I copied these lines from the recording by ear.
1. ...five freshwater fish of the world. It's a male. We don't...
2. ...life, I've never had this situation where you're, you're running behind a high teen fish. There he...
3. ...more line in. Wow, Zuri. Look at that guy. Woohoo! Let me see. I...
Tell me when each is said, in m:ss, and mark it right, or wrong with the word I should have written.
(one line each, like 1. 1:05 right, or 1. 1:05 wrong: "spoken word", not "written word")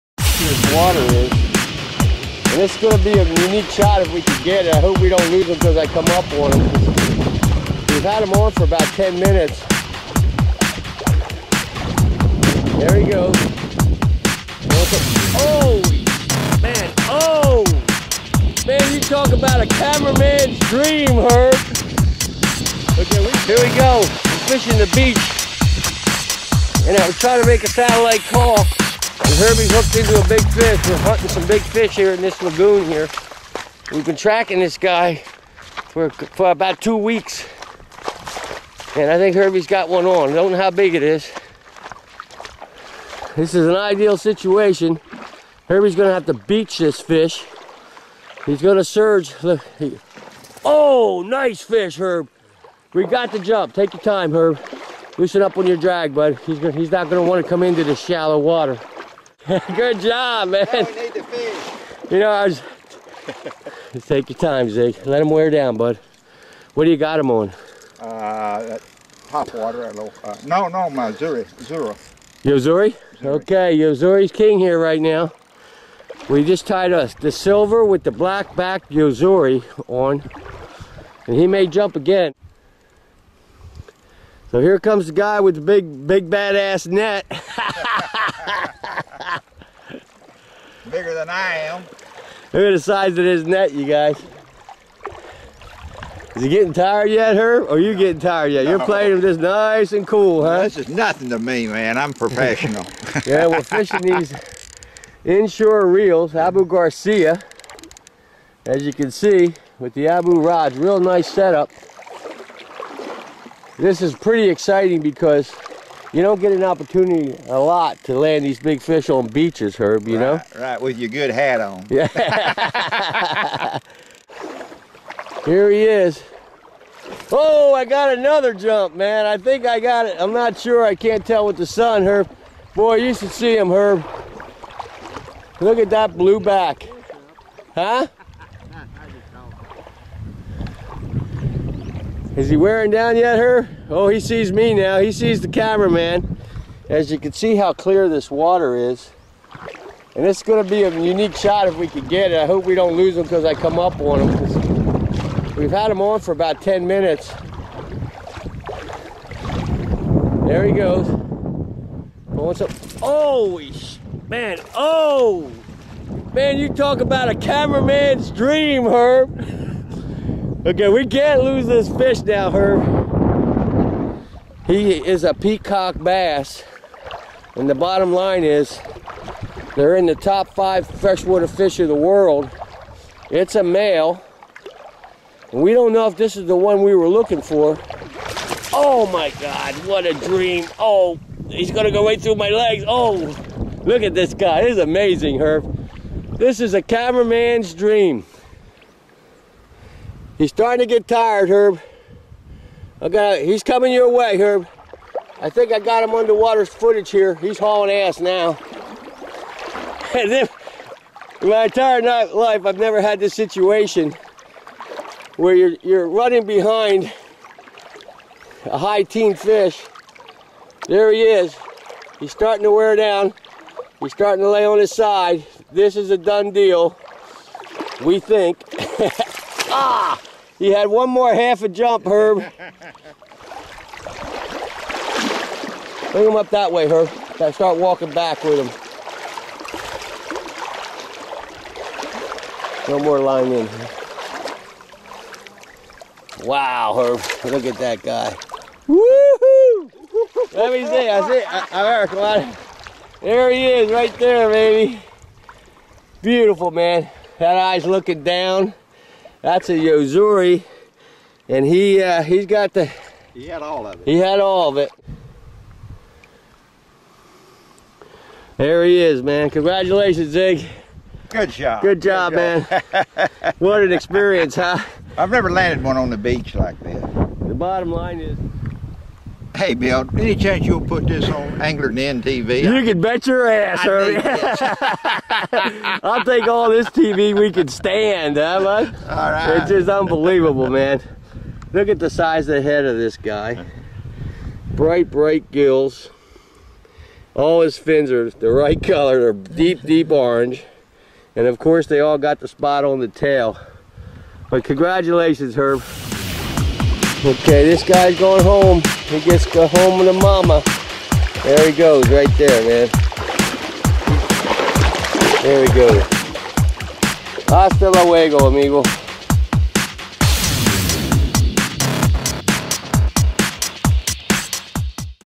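1. 3:00 right
2. 3:32 right
3. 4:03 wrong: "Herb", not "Zuri".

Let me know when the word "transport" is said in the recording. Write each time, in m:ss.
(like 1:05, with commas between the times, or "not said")
not said.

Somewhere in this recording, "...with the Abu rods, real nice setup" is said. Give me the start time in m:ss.
1:49.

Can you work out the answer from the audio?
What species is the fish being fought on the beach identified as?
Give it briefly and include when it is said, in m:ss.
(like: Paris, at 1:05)
peacock bass, at 2:55.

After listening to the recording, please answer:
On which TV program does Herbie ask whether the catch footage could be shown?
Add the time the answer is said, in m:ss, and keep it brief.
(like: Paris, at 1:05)
Anglers Inn TV, at 4:41.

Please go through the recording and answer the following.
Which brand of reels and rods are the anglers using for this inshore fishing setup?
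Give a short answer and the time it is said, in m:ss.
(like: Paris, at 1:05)
Abu Garcia, at 1:46.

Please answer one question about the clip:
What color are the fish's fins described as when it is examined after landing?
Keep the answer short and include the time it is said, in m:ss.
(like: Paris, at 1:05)
deep orange, at 4:59.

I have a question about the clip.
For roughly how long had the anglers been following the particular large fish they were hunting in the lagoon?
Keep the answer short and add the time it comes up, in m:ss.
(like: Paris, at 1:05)
about two weeks, at 0:36.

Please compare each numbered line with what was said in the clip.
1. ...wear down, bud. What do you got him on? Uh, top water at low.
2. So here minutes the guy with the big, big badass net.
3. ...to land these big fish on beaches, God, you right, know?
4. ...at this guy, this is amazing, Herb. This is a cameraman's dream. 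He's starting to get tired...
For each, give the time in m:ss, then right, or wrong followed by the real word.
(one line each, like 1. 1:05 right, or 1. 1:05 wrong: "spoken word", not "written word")
1. 1:05 right
2. 1:24 wrong: "comes", not "minutes"
3. 1:58 wrong: "Herb", not "God"
4. 3:14 right.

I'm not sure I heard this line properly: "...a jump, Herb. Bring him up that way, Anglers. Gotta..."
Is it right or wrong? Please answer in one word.
wrong.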